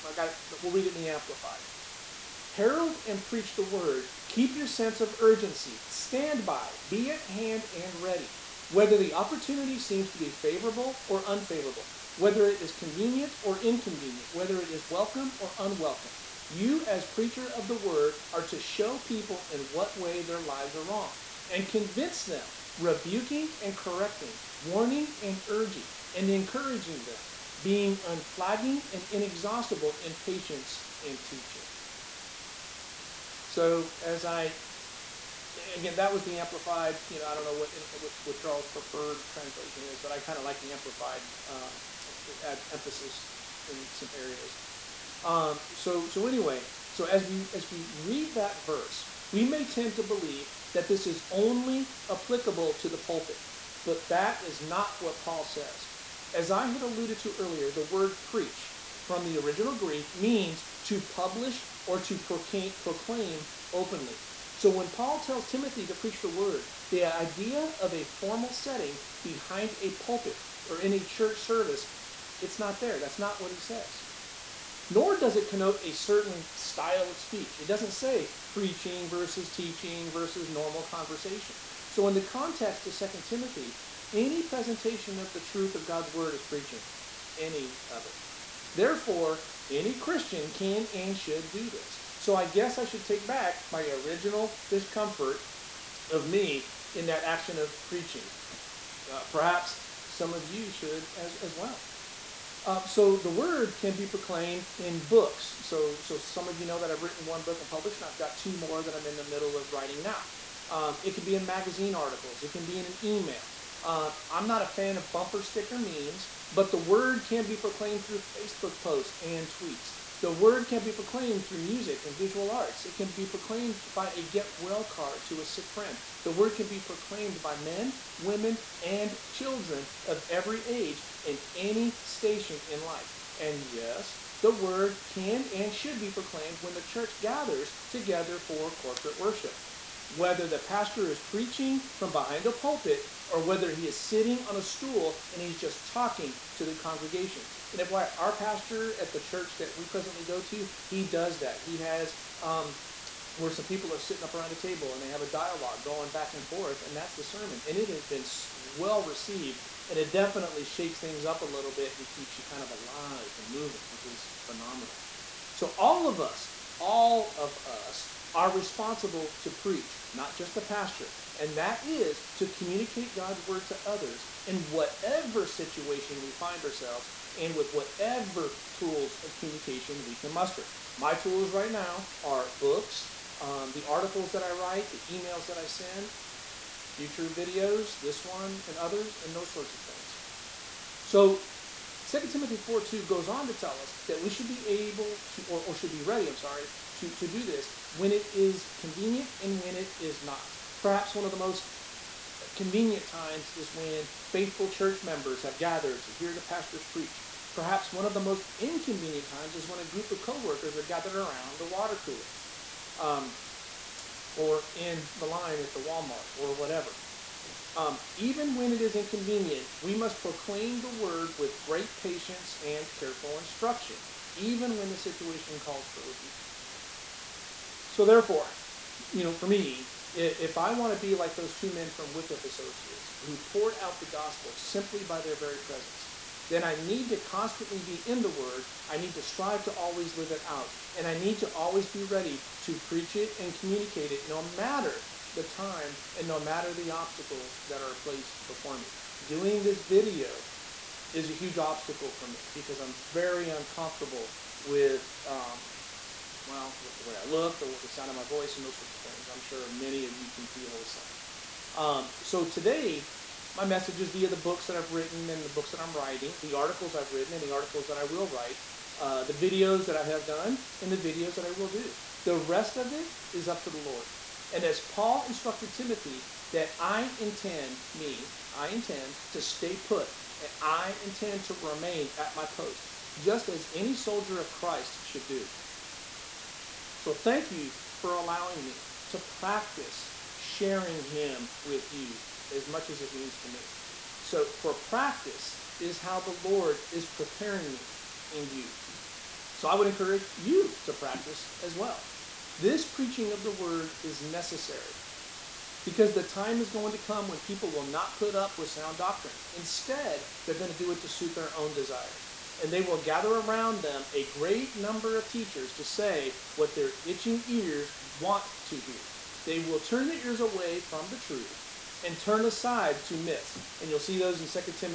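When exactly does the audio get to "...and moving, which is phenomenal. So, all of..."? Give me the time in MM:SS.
02:43.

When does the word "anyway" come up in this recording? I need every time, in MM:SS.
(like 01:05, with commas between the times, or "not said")
00:46.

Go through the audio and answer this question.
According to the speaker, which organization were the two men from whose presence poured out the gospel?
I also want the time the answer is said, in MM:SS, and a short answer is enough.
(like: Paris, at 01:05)
Wycliffe Associates, at 03:52.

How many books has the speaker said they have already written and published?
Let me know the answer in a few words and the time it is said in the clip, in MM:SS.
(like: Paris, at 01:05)
1, at 01:47.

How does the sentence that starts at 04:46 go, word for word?
So thank you for allowing me to practice sharing Him with you as much as it means to me.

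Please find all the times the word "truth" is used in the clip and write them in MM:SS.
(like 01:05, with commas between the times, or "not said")
01:25, 05:21.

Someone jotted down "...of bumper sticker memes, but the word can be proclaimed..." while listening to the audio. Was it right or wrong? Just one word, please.
right.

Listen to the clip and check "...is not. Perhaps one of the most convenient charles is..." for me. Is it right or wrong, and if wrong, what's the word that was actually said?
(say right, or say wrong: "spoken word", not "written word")
wrong: "times", not "charles".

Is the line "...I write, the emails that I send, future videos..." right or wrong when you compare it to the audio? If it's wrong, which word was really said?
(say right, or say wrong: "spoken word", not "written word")
right.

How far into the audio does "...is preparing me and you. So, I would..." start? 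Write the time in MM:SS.
04:56.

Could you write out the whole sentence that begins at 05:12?
And they will gather around them a great number of teachers to say what their itching ears want to hear.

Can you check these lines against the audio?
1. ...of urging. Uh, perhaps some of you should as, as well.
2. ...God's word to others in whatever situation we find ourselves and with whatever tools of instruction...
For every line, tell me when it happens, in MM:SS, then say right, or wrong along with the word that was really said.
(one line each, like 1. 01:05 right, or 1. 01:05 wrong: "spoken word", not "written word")
1. 01:37 wrong: "preaching", not "urging"
2. 02:53 wrong: "communication", not "instruction".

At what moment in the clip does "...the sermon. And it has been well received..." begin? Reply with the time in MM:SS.
02:37.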